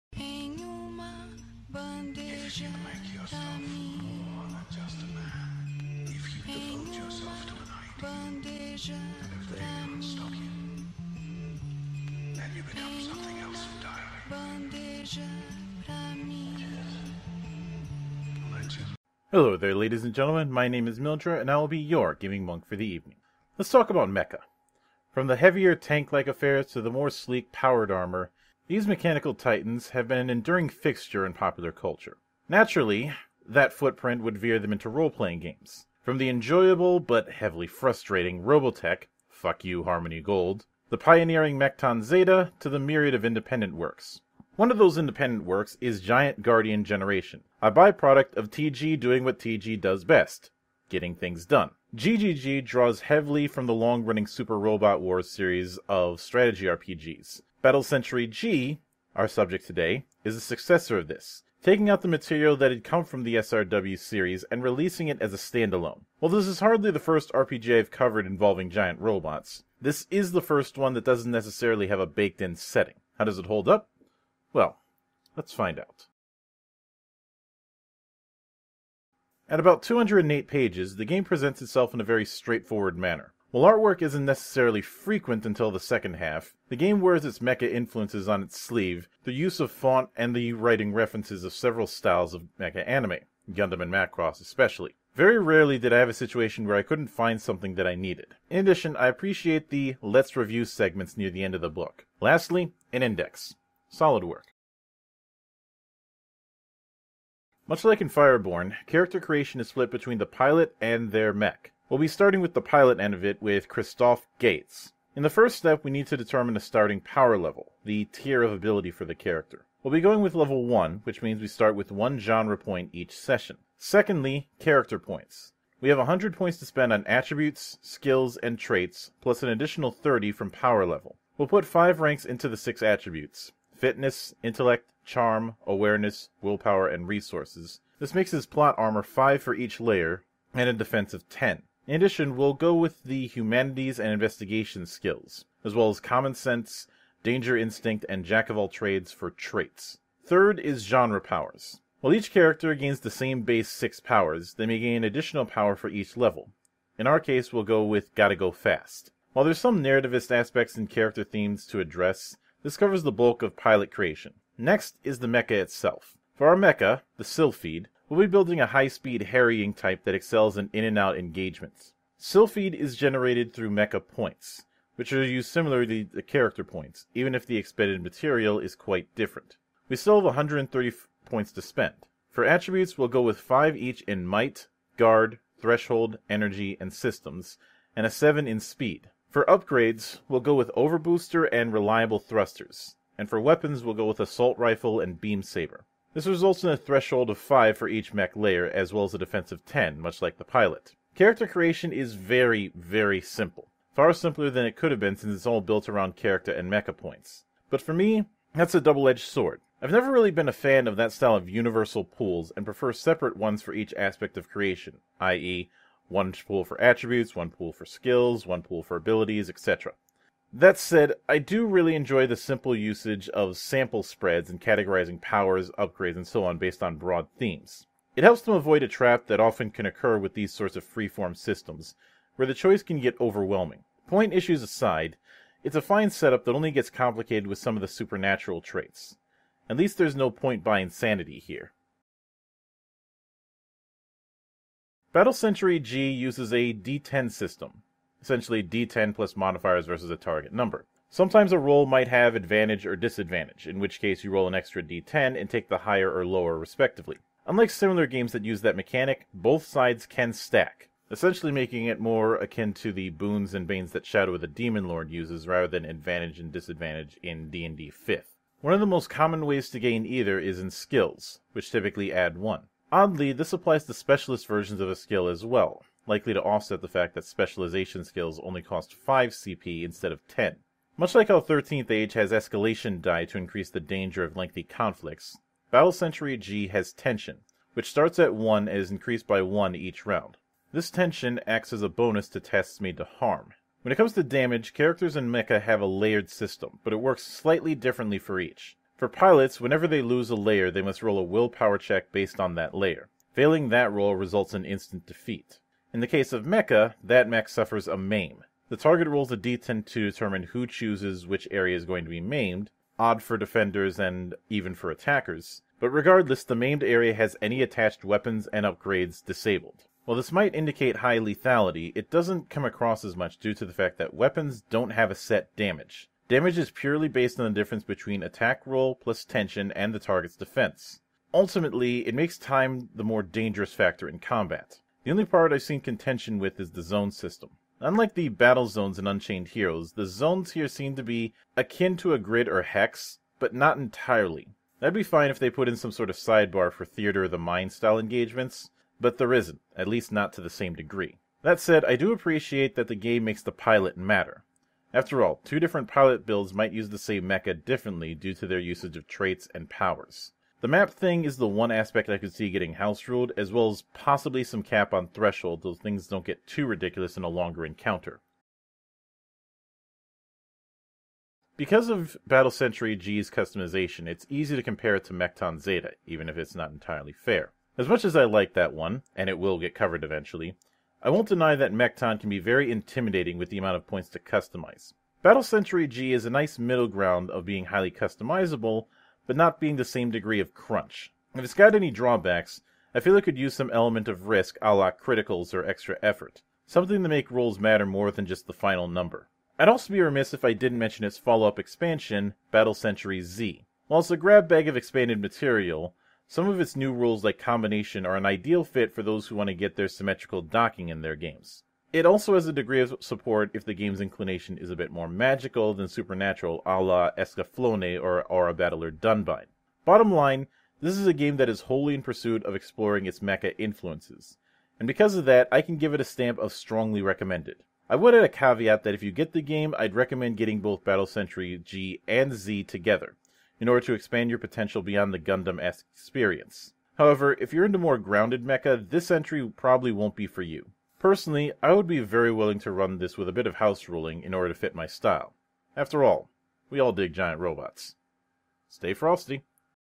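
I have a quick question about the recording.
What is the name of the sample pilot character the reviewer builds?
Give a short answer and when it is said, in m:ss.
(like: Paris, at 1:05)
Christoph Gates, at 1:53.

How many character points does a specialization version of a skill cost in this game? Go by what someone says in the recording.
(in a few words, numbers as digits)
5.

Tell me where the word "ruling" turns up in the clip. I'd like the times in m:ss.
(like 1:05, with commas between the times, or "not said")
7:23.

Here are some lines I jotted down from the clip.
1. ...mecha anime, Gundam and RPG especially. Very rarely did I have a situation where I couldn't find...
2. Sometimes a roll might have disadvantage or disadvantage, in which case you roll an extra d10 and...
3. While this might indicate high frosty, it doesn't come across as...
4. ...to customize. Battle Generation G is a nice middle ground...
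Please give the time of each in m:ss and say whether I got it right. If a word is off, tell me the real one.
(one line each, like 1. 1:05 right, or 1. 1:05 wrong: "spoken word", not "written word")
1. 1:32 wrong: "Macross", not "RPG"
2. 4:11 wrong: "advantage", not "disadvantage"
3. 5:20 wrong: "lethality", not "frosty"
4. 6:24 wrong: "Century", not "Generation".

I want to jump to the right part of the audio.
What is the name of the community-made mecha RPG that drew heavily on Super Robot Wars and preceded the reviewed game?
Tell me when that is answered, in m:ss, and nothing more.
0:45.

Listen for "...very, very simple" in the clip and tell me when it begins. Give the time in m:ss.
3:22.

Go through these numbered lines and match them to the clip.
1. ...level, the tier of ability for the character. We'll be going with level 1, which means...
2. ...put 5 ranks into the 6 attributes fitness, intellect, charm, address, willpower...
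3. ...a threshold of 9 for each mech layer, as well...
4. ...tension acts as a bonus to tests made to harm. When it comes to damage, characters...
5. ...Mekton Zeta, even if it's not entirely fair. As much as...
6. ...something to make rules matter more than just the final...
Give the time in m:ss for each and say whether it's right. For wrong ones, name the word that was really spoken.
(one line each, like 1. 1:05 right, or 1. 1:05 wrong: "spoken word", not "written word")
1. 1:57 right
2. 2:11 wrong: "awareness", not "address"
3. 3:16 wrong: "5", not "9"
4. 4:50 right
5. 6:15 right
6. 6:36 right.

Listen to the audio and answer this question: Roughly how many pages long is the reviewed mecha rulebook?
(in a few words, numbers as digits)
208.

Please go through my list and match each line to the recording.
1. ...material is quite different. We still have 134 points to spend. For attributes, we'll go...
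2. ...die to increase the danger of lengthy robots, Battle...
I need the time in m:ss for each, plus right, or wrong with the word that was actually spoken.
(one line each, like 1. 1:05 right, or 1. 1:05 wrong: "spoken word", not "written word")
1. 2:58 wrong: "130", not "134"
2. 4:43 wrong: "conflicts", not "robots".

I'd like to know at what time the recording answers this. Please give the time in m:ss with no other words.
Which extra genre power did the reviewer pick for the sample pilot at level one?
2:38.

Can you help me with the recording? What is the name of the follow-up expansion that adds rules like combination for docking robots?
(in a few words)
Battle Century Z.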